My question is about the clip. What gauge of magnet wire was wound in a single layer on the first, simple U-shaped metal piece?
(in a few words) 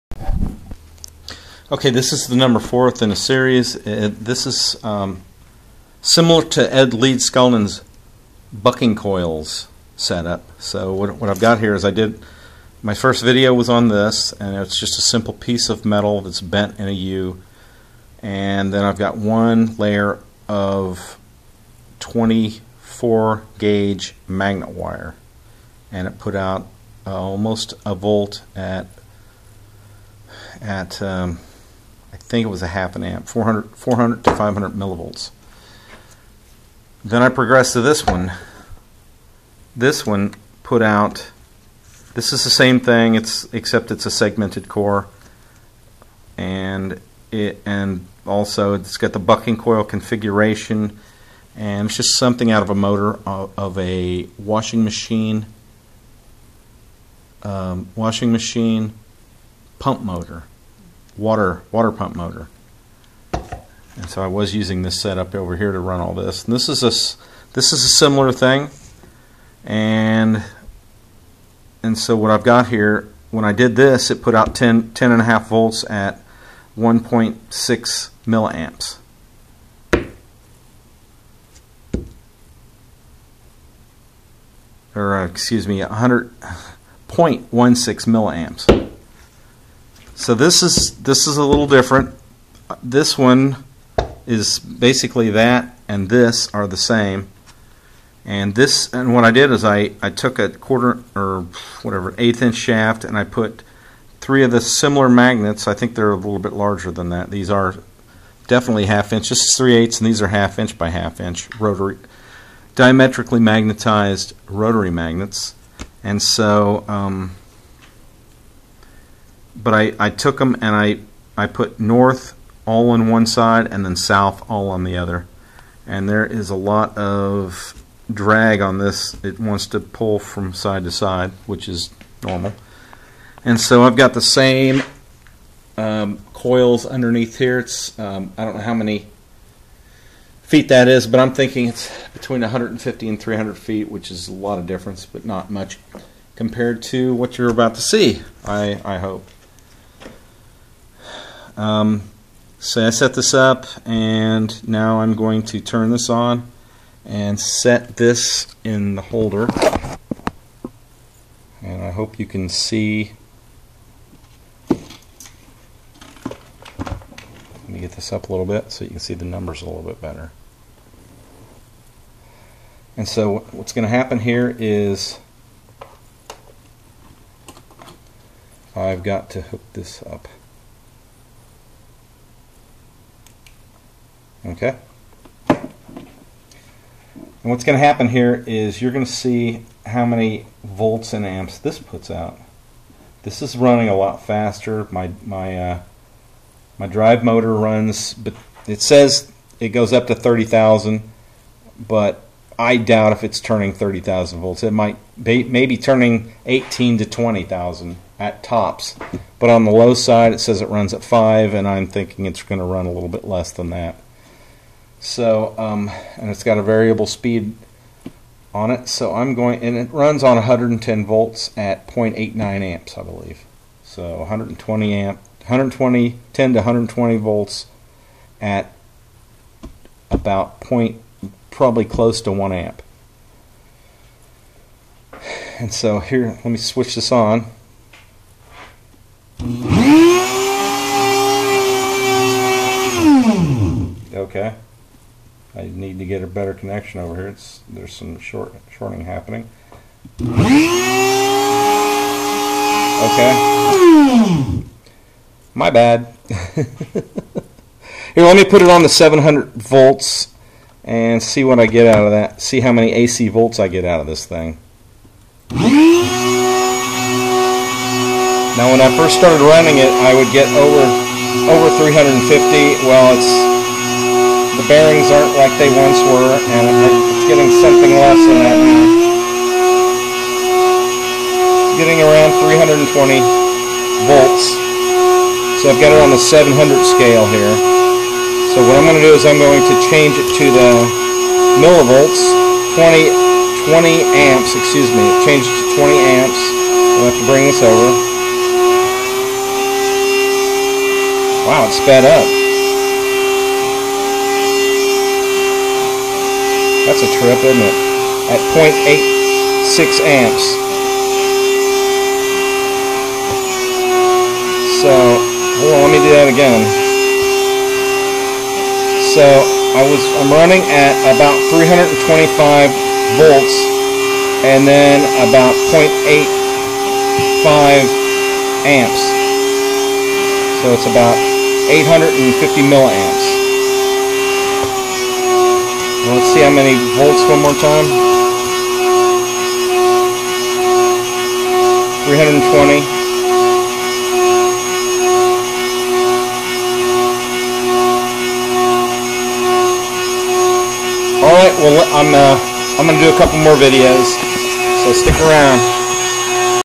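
24 gauge.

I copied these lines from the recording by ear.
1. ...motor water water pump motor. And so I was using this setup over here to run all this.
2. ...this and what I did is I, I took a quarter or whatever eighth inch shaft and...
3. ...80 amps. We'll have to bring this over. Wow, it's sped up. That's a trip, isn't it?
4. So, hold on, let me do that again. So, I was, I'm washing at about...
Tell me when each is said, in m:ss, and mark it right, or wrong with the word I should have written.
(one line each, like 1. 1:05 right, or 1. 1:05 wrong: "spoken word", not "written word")
1. 1:00 right
2. 1:38 right
3. 4:55 wrong: "20", not "80"
4. 5:14 wrong: "running", not "washing".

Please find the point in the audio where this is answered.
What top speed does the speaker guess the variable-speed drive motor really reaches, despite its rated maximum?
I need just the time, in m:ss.
3:26.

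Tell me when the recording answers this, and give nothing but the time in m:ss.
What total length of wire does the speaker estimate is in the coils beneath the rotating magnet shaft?
2:22.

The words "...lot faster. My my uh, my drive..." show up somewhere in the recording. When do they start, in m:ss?
3:13.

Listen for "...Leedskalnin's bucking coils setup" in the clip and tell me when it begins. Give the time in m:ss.
0:06.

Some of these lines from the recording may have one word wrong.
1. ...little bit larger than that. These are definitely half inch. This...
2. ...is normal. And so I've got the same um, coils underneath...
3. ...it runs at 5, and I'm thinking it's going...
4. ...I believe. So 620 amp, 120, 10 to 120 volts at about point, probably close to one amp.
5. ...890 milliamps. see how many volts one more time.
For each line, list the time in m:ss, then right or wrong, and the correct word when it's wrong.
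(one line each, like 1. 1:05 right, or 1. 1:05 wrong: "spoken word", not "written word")
1. 1:46 right
2. 2:11 right
3. 3:30 right
4. 3:42 wrong: "120", not "620"
5. 5:31 wrong: "850", not "890".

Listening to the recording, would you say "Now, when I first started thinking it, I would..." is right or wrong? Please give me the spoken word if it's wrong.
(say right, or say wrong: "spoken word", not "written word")
wrong: "running", not "thinking".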